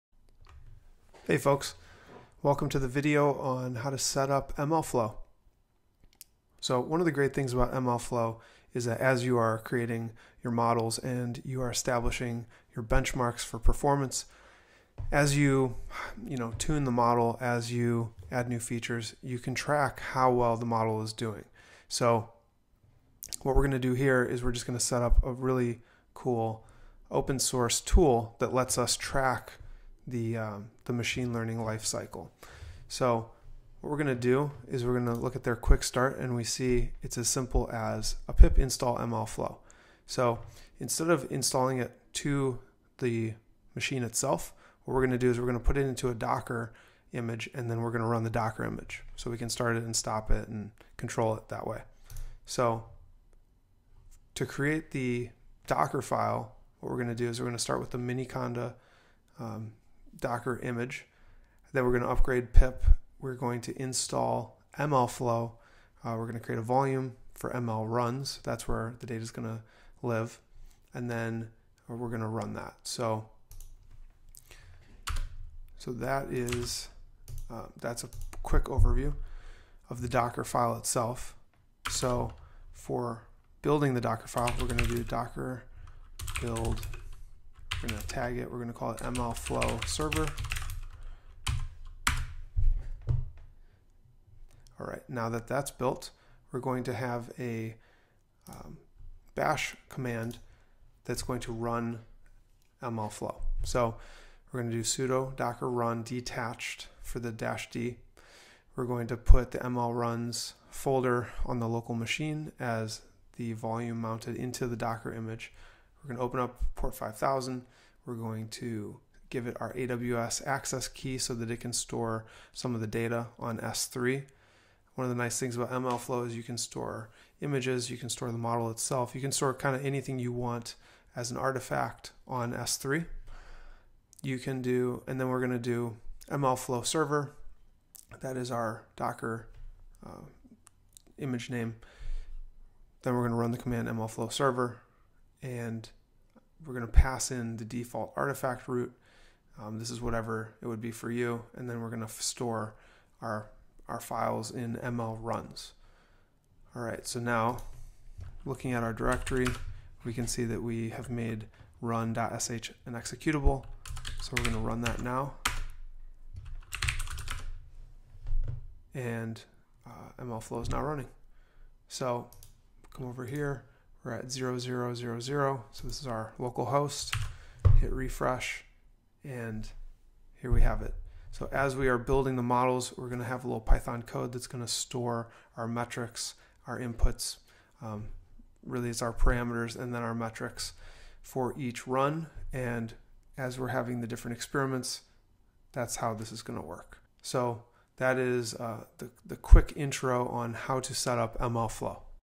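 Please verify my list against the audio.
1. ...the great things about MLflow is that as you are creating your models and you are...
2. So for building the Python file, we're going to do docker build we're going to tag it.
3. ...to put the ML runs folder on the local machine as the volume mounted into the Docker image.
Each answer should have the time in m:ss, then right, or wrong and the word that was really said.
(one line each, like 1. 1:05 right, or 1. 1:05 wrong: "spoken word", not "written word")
1. 0:07 right
2. 1:21 wrong: "Docker", not "Python"
3. 1:49 right.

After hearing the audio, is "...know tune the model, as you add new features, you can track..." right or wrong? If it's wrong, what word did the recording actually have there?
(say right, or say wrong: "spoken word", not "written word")
right.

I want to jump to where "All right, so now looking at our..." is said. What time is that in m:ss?
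2:36.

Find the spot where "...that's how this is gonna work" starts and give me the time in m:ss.
3:15.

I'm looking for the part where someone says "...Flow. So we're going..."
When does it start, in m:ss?
1:43.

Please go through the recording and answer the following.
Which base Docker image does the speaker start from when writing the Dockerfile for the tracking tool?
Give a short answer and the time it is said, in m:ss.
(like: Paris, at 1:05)
miniconda, at 0:57.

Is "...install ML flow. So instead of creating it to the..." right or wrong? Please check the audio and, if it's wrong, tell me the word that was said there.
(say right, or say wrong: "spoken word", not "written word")
wrong: "installing", not "creating".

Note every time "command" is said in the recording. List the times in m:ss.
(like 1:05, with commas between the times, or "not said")
1:39, 2:23.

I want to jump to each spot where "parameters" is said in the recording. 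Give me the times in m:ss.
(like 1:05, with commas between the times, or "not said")
3:09.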